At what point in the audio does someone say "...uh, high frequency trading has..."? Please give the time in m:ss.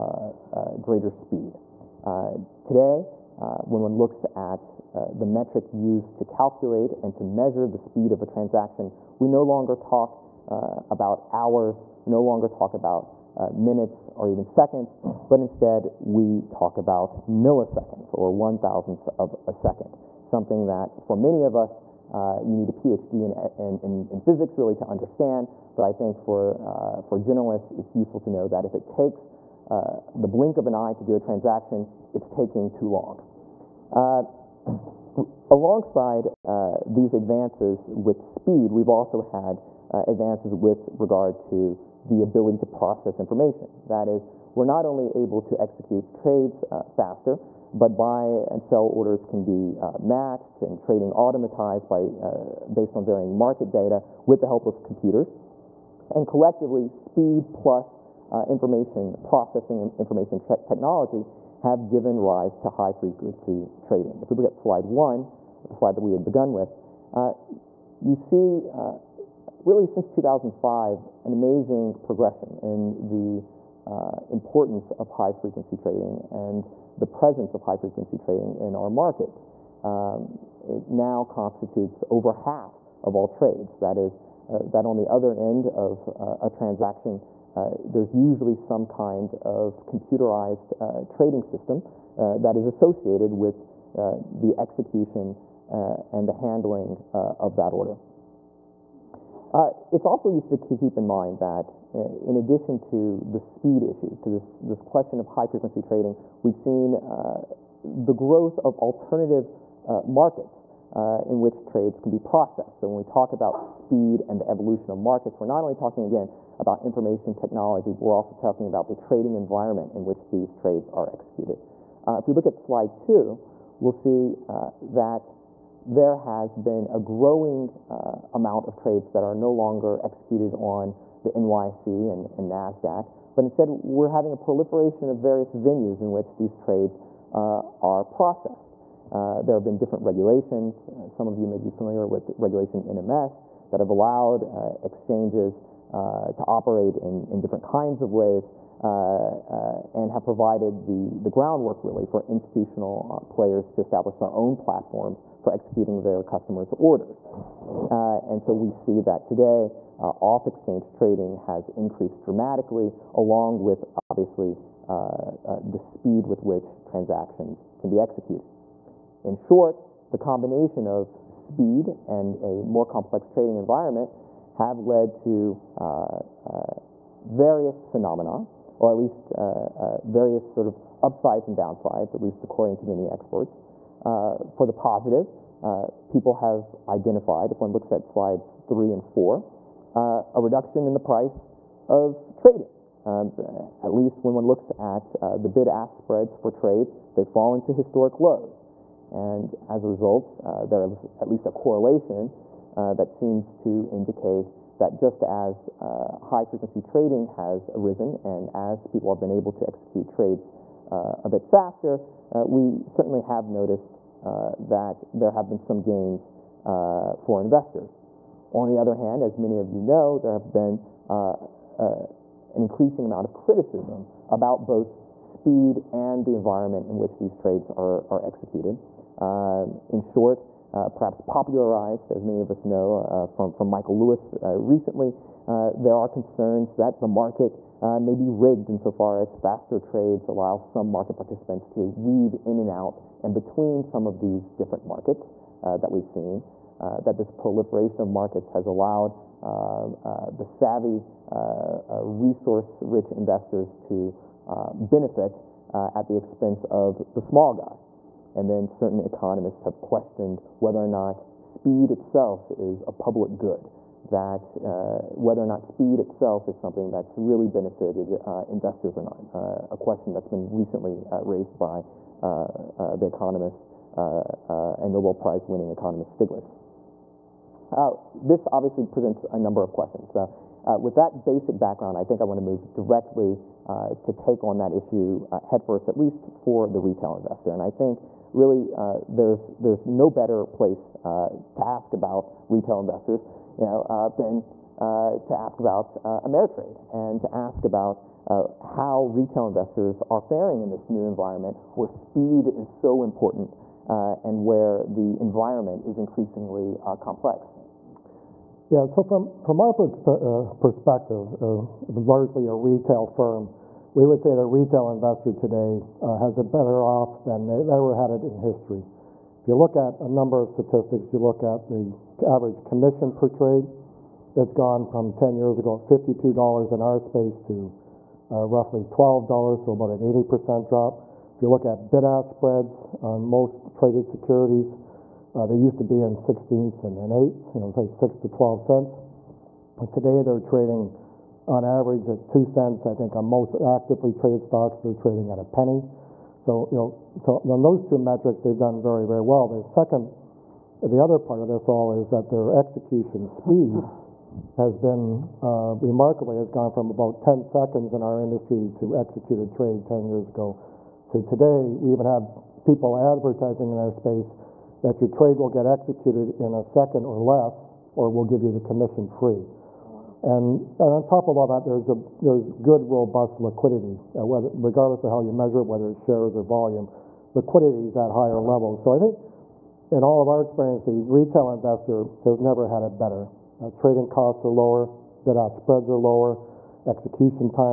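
3:25.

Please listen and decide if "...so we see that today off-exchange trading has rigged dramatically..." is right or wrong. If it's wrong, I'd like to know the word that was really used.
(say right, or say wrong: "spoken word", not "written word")
wrong: "increased", not "rigged".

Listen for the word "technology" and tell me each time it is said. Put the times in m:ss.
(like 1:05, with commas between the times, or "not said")
1:00, 1:57.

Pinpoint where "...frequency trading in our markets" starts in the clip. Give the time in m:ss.
1:17.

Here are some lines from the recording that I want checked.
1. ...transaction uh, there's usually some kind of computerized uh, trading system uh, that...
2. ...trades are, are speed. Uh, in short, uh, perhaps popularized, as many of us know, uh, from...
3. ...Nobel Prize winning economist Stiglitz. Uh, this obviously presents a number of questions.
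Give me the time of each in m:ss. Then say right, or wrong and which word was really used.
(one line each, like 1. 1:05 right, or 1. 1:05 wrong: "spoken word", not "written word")
1. 1:26 right
2. 3:47 wrong: "executed", not "speed"
3. 4:34 right.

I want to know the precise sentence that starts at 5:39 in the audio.
And today they're trading on average at 2 cents.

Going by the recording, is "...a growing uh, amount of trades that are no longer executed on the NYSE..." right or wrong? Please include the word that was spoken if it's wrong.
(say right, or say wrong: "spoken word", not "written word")
right.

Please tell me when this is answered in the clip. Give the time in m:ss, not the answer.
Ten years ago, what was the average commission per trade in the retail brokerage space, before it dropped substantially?
5:25.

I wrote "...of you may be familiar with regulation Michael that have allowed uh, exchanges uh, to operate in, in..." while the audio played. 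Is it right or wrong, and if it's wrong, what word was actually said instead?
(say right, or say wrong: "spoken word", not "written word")
wrong: "NMS", not "Michael".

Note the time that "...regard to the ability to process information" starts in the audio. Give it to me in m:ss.
0:40.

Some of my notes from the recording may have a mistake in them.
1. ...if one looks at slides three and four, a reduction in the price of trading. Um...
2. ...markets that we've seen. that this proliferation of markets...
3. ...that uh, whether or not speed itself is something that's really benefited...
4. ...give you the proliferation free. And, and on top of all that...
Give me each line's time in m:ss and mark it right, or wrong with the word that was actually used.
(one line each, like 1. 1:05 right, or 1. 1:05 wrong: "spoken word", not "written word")
1. 3:07 right
2. 4:04 right
3. 4:24 right
4. 6:08 wrong: "commission", not "proliferation".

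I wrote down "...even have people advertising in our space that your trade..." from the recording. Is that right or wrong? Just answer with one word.
right.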